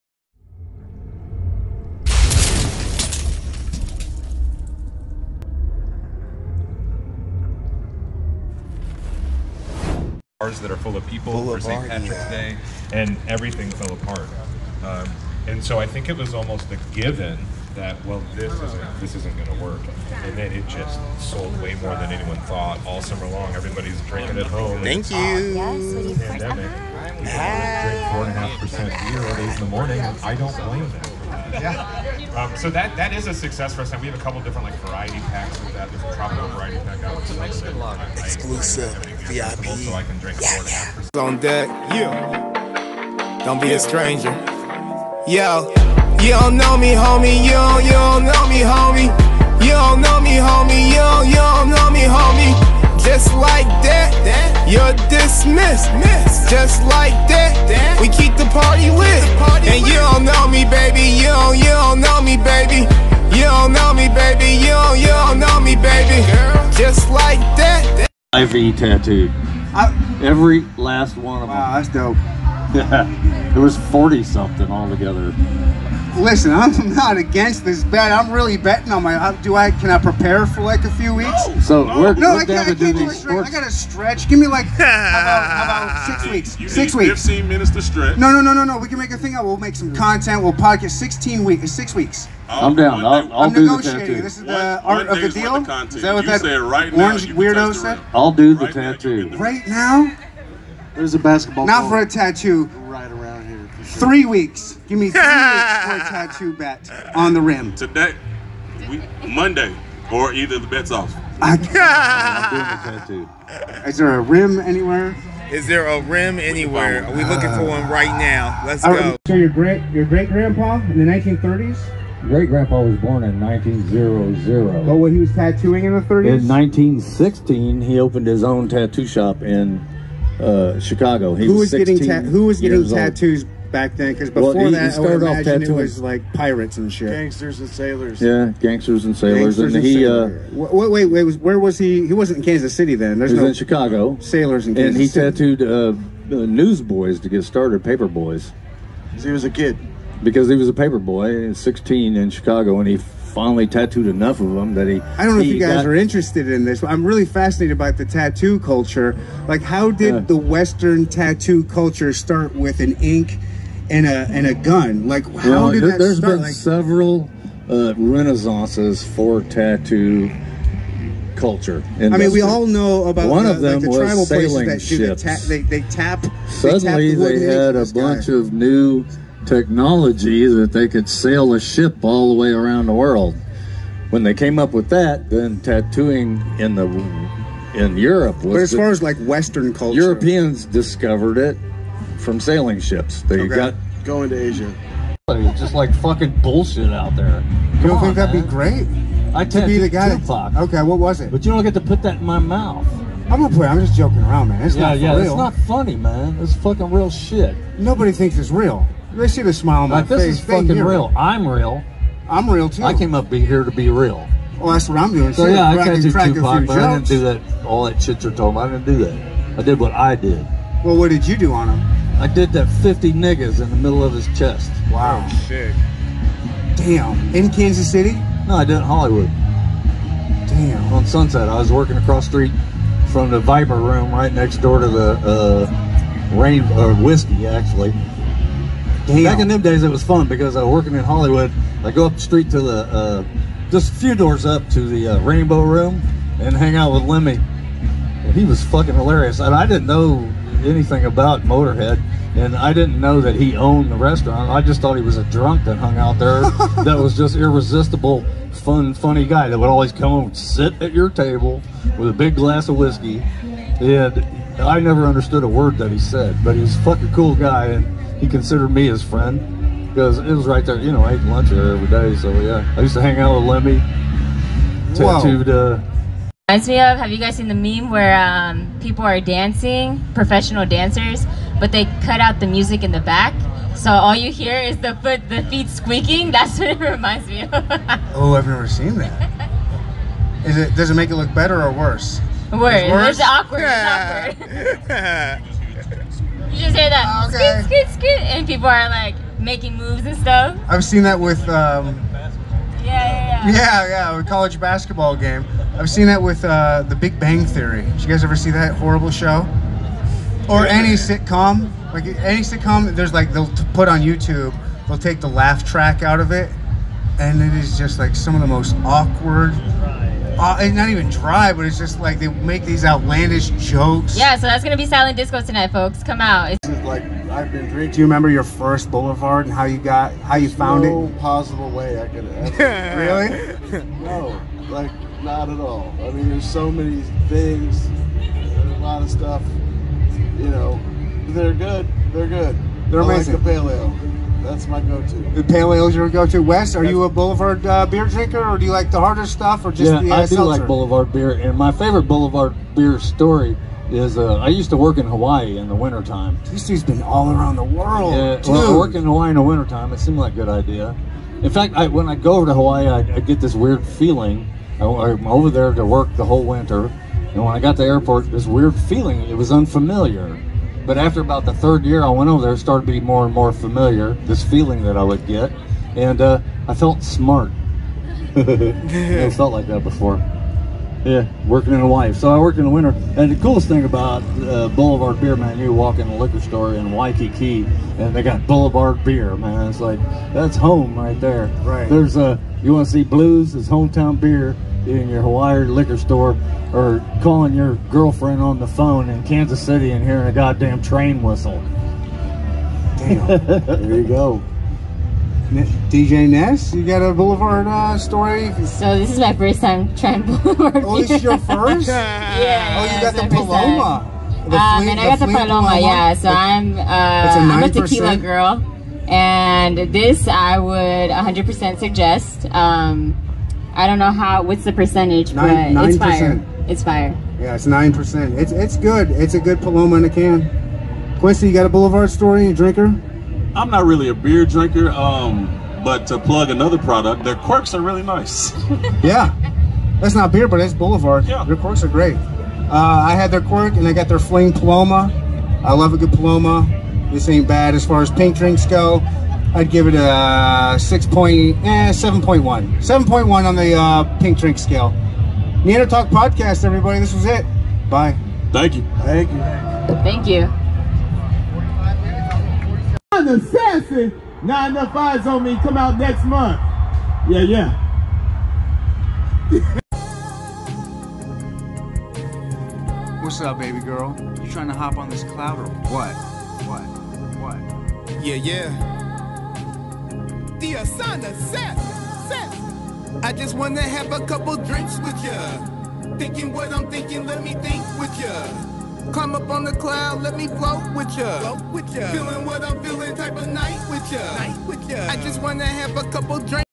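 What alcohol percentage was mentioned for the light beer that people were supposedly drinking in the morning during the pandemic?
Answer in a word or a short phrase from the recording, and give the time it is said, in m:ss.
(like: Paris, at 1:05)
4.5%, at 0:28.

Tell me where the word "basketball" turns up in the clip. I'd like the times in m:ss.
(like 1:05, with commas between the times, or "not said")
1:41, 5:04.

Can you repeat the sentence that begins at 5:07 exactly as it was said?
Did you guys ever see that horrible show?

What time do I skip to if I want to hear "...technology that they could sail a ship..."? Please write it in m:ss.
2:59.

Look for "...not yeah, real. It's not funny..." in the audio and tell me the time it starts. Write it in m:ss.
3:24.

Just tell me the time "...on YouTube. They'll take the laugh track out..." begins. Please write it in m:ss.
5:13.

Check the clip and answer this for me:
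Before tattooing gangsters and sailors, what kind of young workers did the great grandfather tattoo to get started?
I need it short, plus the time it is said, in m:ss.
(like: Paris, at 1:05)
Paper boys, at 2:26.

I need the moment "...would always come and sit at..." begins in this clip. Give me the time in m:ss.
4:19.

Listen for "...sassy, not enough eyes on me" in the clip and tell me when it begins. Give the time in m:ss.
7:43.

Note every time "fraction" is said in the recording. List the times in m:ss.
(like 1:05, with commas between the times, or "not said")
not said.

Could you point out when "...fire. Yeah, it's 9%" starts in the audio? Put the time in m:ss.
7:06.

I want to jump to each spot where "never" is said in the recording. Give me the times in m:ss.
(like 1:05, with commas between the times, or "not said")
4:24, 4:48.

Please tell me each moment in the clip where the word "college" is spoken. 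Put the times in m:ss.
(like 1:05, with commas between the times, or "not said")
5:04.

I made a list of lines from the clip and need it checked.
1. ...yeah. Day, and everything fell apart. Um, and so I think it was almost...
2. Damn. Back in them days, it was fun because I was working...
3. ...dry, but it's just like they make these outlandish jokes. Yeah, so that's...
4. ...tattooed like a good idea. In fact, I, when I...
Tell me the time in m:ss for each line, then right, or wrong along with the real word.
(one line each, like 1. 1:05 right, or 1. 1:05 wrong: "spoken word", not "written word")
1. 0:12 right
2. 3:59 right
3. 5:21 right
4. 5:59 wrong: "seemed", not "tattooed".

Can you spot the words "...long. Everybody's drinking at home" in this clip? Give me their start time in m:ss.
0:23.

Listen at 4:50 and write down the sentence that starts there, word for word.
Does it make it look better or worse?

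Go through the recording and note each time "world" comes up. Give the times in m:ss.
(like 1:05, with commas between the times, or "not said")
3:02, 5:57.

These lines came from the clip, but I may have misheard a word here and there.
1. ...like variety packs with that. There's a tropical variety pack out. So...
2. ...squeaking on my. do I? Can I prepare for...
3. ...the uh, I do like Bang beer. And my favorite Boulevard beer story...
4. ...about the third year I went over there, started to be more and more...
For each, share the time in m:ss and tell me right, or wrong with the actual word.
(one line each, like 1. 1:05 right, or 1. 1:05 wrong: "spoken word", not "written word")
1. 0:34 right
2. 1:18 wrong: "betting", not "squeaking"
3. 5:50 wrong: "Boulevard", not "Bang"
4. 6:11 right.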